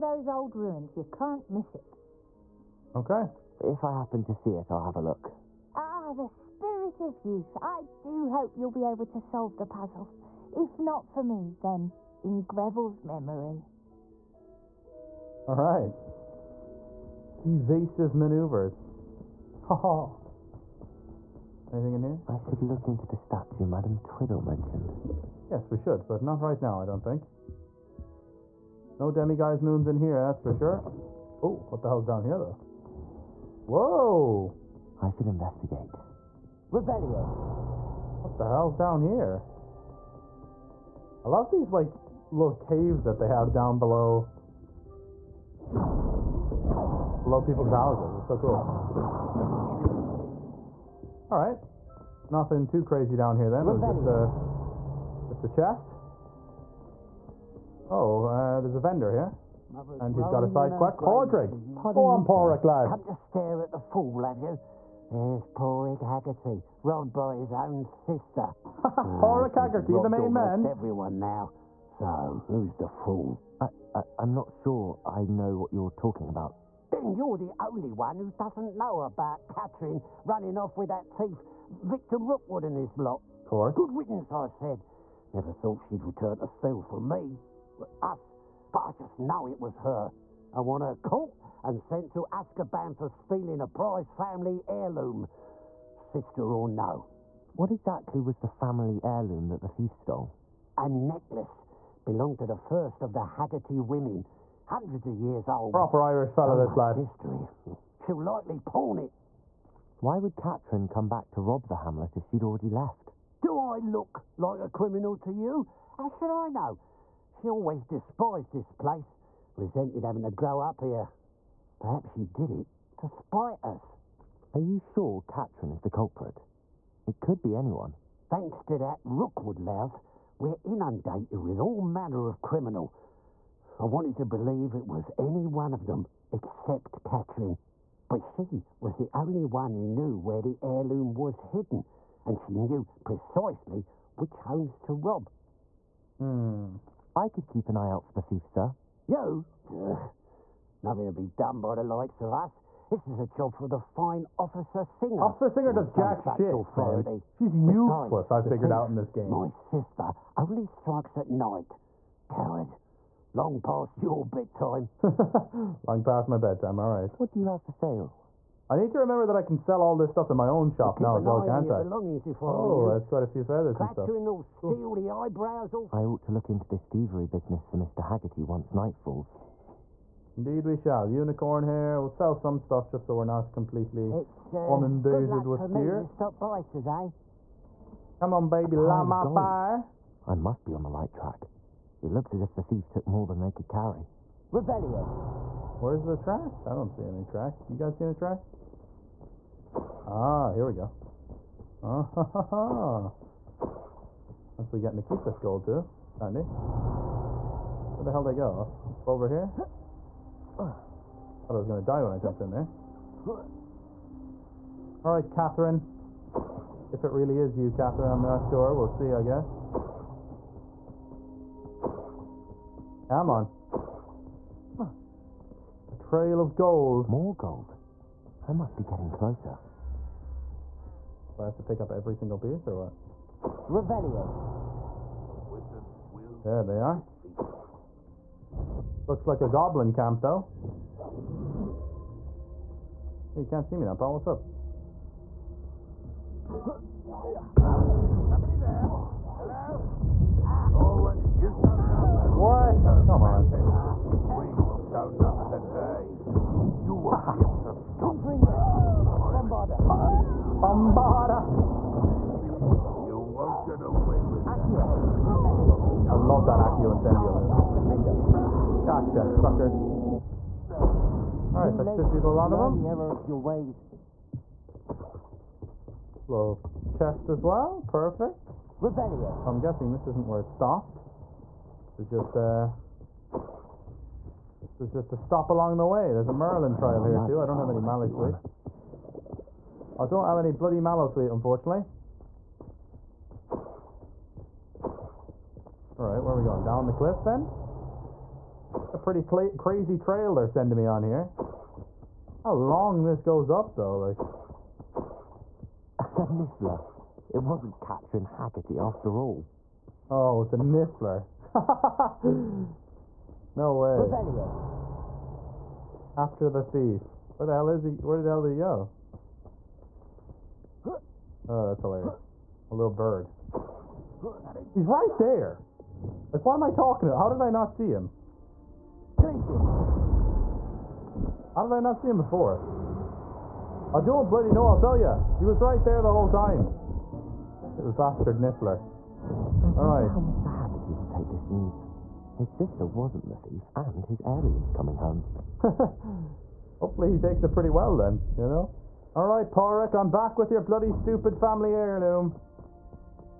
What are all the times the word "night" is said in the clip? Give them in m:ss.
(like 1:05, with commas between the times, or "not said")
2:41, 2:58.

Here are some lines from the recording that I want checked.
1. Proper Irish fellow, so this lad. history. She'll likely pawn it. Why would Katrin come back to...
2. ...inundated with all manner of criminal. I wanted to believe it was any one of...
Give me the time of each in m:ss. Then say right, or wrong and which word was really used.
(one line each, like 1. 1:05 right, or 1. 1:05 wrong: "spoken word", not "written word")
1. 1:45 right
2. 2:10 right.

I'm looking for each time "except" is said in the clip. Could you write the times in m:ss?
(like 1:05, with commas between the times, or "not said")
2:16.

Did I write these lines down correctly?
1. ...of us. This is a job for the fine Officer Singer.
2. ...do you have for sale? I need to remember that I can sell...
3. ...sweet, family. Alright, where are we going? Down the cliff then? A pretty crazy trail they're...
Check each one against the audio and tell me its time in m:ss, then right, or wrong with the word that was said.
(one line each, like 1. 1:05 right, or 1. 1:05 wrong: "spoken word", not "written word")
1. 2:32 right
2. 2:47 right
3. 4:51 wrong: "unfortunately", not "family".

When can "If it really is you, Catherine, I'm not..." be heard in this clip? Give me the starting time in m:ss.
3:36.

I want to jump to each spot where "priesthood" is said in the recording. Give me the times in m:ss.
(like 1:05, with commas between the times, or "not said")
not said.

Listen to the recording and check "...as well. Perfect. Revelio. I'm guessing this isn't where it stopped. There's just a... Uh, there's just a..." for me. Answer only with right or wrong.
right.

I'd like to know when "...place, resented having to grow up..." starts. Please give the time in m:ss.
1:58.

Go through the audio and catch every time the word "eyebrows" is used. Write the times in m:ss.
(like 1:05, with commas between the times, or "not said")
2:55.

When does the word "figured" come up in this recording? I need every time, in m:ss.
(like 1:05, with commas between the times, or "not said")
2:38.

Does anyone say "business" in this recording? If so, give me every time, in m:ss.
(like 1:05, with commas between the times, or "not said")
2:57.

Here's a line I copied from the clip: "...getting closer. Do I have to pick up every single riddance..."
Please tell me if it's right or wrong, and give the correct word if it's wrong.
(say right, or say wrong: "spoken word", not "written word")
wrong: "piece", not "riddance".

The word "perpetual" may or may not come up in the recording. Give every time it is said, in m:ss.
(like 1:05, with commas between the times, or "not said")
not said.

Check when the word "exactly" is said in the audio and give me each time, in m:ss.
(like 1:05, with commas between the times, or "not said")
1:37.